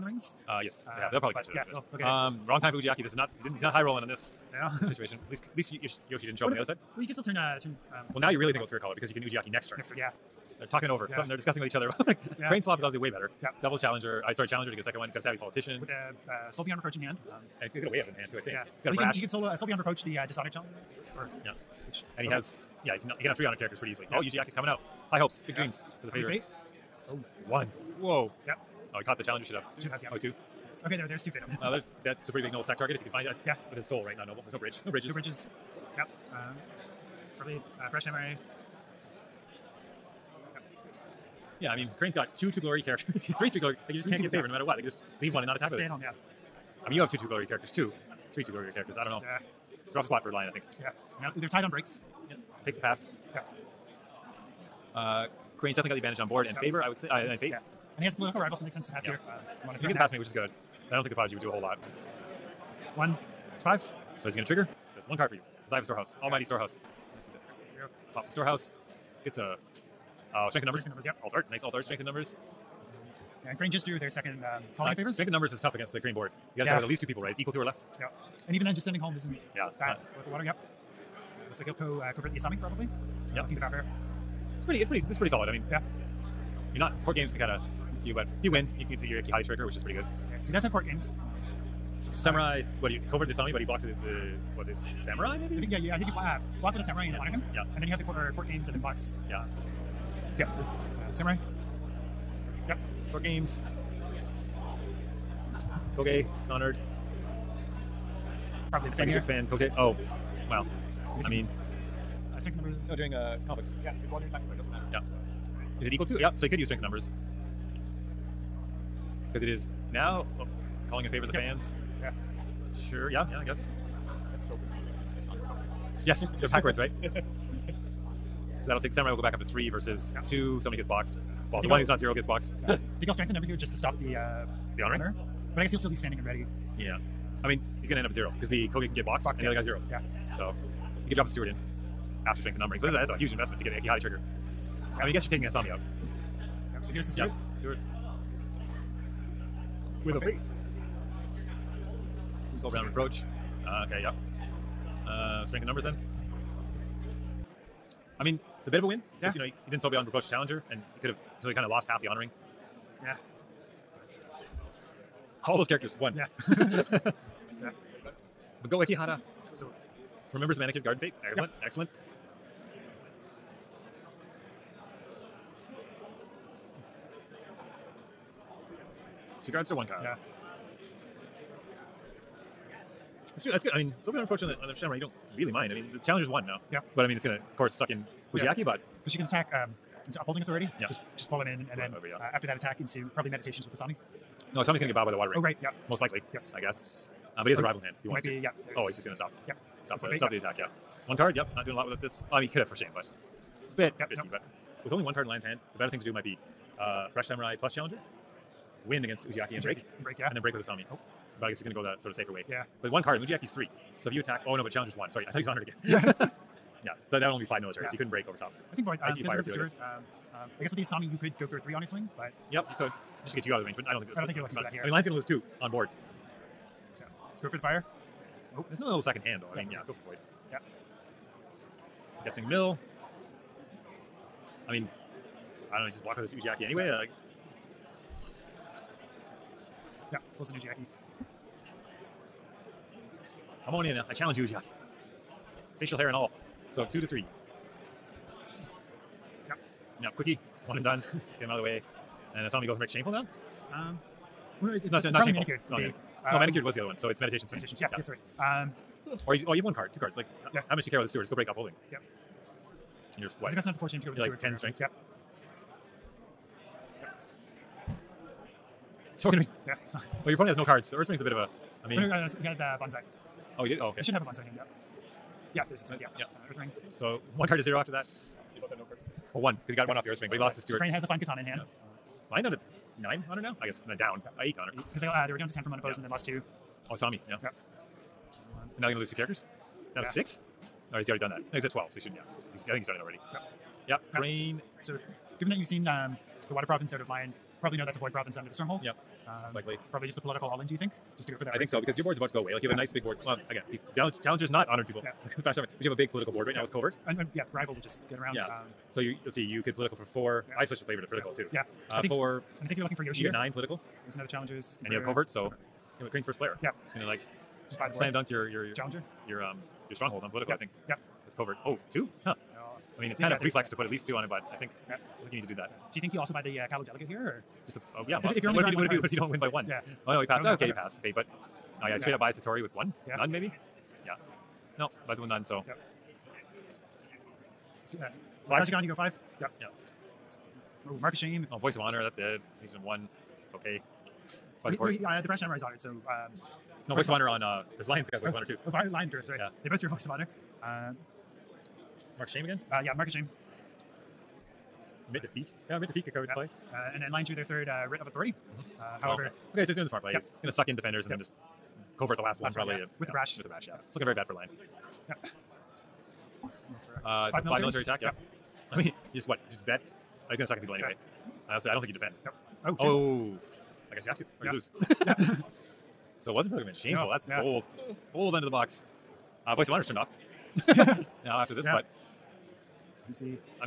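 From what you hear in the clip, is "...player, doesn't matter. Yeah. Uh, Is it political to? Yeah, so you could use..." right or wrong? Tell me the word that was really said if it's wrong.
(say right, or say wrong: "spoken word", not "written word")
wrong: "equal", not "political".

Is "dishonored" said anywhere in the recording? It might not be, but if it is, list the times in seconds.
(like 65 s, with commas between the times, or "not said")
20 s, 125 s.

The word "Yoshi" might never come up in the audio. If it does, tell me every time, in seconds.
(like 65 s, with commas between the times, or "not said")
6 s, 313 s.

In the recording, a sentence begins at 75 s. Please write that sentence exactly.
Strength in numbers is tough against the Crane board.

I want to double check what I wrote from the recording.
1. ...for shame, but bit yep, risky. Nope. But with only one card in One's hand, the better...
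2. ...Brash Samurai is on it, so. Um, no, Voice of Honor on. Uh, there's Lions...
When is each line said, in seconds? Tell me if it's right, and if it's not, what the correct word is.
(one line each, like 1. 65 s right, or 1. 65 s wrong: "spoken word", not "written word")
1. 202 s wrong: "Lion", not "One"
2. 345 s right.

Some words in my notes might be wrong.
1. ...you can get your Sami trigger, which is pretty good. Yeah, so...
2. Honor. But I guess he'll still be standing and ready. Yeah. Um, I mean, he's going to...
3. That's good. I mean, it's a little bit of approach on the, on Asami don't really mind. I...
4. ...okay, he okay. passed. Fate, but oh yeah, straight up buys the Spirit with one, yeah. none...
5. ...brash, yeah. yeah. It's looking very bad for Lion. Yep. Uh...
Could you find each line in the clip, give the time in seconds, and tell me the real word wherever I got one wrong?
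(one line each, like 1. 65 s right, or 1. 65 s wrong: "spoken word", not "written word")
1. 88 s wrong: "Kihati", not "Sami"
2. 134 s right
3. 183 s wrong: "You", not "Asami"
4. 330 s wrong: "Tory", not "Spirit"
5. 363 s right.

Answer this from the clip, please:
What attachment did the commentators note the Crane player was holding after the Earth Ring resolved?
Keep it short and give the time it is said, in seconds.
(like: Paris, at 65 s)
Fine Katana, at 281 s.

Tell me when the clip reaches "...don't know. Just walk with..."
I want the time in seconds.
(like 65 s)
235 s.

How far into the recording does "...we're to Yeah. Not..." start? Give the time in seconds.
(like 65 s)
269 s.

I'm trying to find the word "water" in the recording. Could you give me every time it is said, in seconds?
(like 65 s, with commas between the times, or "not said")
80 s, 195 s, 296 s.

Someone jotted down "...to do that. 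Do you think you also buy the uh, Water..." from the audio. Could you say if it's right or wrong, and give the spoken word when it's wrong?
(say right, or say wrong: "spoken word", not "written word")
wrong: "Delegate", not "Water".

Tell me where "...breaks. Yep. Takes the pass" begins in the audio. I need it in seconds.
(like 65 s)
51 s.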